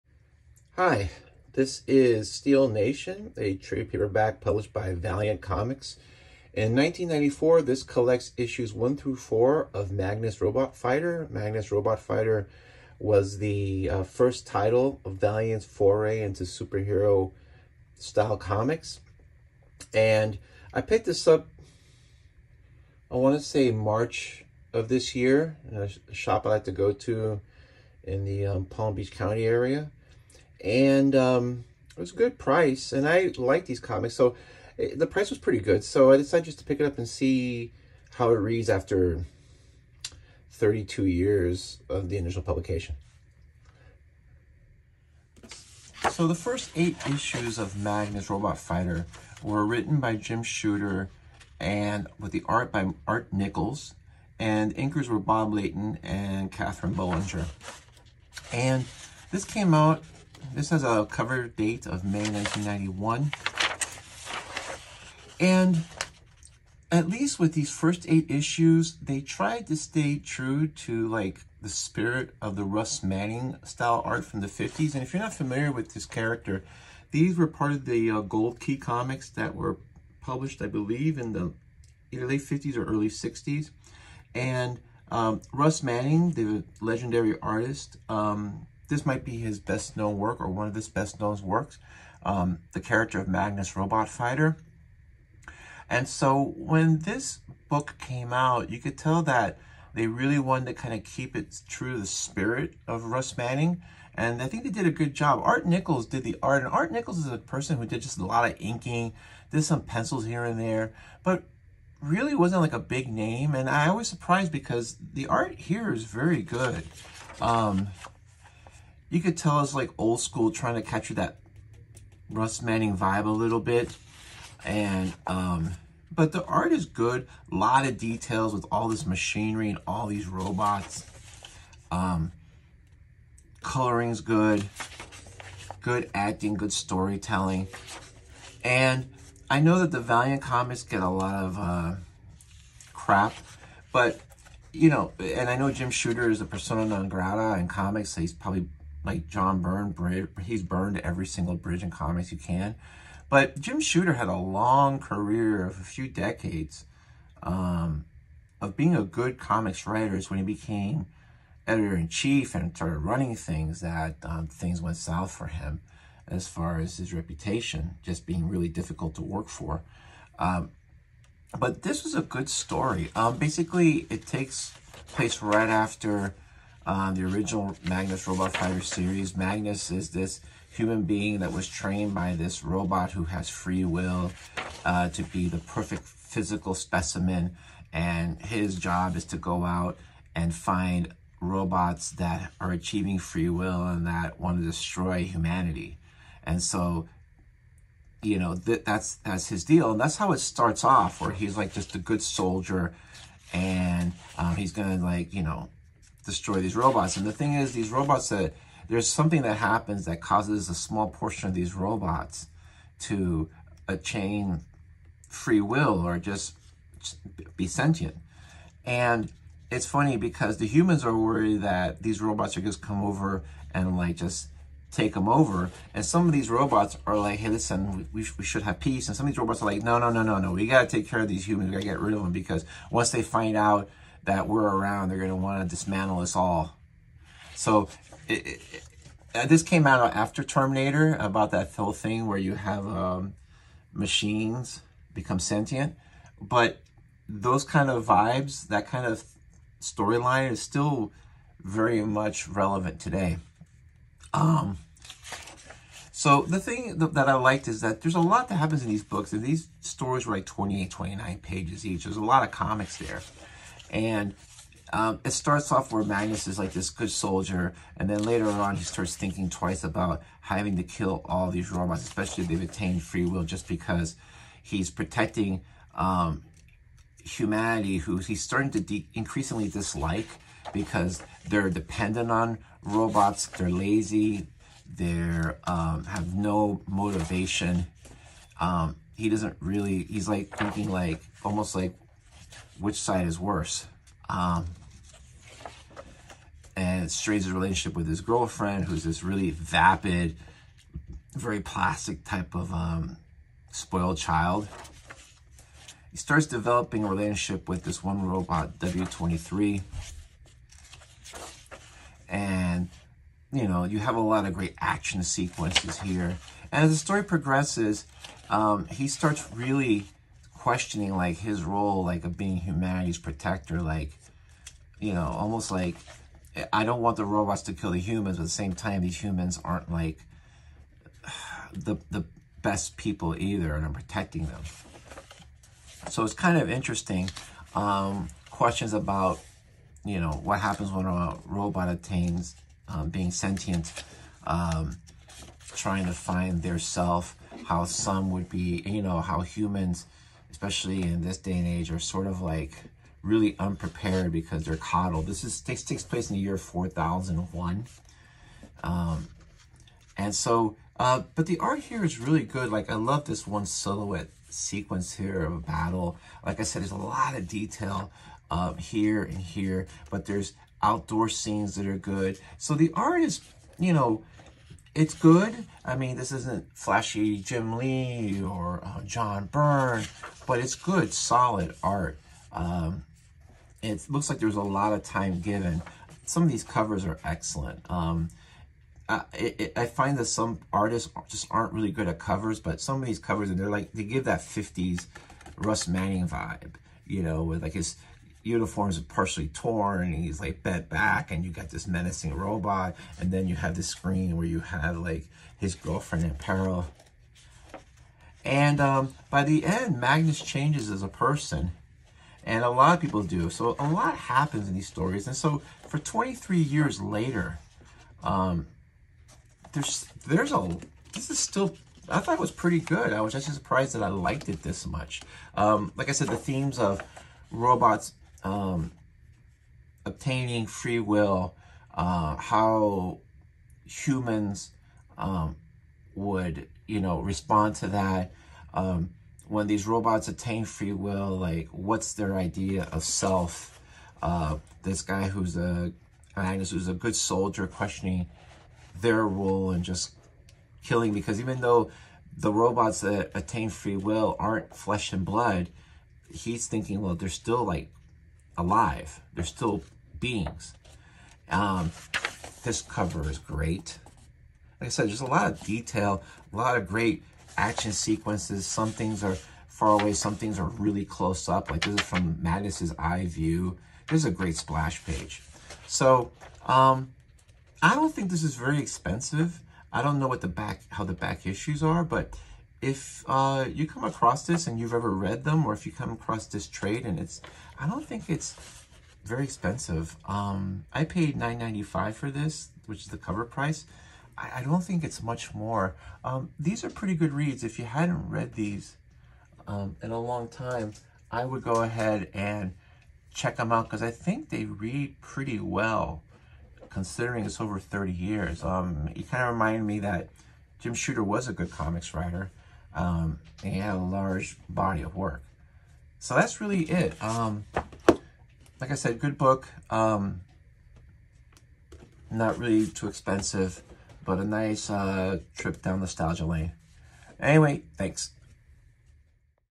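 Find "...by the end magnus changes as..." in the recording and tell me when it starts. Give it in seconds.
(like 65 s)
409 s.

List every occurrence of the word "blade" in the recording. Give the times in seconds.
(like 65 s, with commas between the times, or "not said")
not said.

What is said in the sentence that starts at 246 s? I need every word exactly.
But those kind of vibes, that kind of storyline is still very much relevant today.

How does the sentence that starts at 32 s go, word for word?
And I like these comics, so it, eh, the price was pretty good.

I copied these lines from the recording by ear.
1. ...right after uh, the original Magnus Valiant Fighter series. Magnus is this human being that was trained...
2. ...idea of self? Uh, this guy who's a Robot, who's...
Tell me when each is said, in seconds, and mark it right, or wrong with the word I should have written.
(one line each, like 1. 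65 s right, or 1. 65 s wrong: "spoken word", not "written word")
1. 175 s wrong: "Robot", not "Valiant"
2. 442 s wrong: "Magnus", not "Robot".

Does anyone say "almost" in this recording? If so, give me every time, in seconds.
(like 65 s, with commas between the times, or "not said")
291 s, 325 s.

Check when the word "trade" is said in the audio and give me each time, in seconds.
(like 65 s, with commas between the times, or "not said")
3 s, 486 s.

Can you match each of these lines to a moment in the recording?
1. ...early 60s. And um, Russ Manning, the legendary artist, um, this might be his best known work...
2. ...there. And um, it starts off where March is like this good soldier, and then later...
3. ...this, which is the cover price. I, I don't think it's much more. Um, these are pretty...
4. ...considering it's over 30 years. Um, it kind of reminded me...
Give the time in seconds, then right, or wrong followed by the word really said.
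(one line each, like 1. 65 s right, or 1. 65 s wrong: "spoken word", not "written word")
1. 82 s right
2. 262 s wrong: "Magnus", not "March"
3. 492 s right
4. 506 s right.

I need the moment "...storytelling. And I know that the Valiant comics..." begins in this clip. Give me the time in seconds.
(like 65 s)
136 s.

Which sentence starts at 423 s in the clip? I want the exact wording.
I was actually surprised that I liked it this much.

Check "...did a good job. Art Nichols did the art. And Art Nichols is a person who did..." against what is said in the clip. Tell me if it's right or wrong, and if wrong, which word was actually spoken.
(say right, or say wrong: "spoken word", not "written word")
right.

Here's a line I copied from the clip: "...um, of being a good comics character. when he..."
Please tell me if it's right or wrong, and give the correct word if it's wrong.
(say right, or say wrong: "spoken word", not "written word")
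wrong: "writer", not "character".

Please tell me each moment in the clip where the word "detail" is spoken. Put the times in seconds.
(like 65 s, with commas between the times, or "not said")
127 s, 367 s, 465 s.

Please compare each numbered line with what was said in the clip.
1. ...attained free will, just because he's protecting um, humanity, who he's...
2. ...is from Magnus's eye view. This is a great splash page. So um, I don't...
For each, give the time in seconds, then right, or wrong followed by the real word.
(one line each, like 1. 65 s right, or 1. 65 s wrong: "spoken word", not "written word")
1. 272 s right
2. 471 s right.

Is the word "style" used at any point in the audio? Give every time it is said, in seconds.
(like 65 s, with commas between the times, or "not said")
17 s, 73 s.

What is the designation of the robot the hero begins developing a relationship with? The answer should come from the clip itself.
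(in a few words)
W23.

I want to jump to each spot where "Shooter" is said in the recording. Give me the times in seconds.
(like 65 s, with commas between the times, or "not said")
50 s, 145 s, 153 s, 510 s.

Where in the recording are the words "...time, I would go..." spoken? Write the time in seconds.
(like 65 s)
500 s.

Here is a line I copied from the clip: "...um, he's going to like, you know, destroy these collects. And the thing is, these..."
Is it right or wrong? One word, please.
wrong.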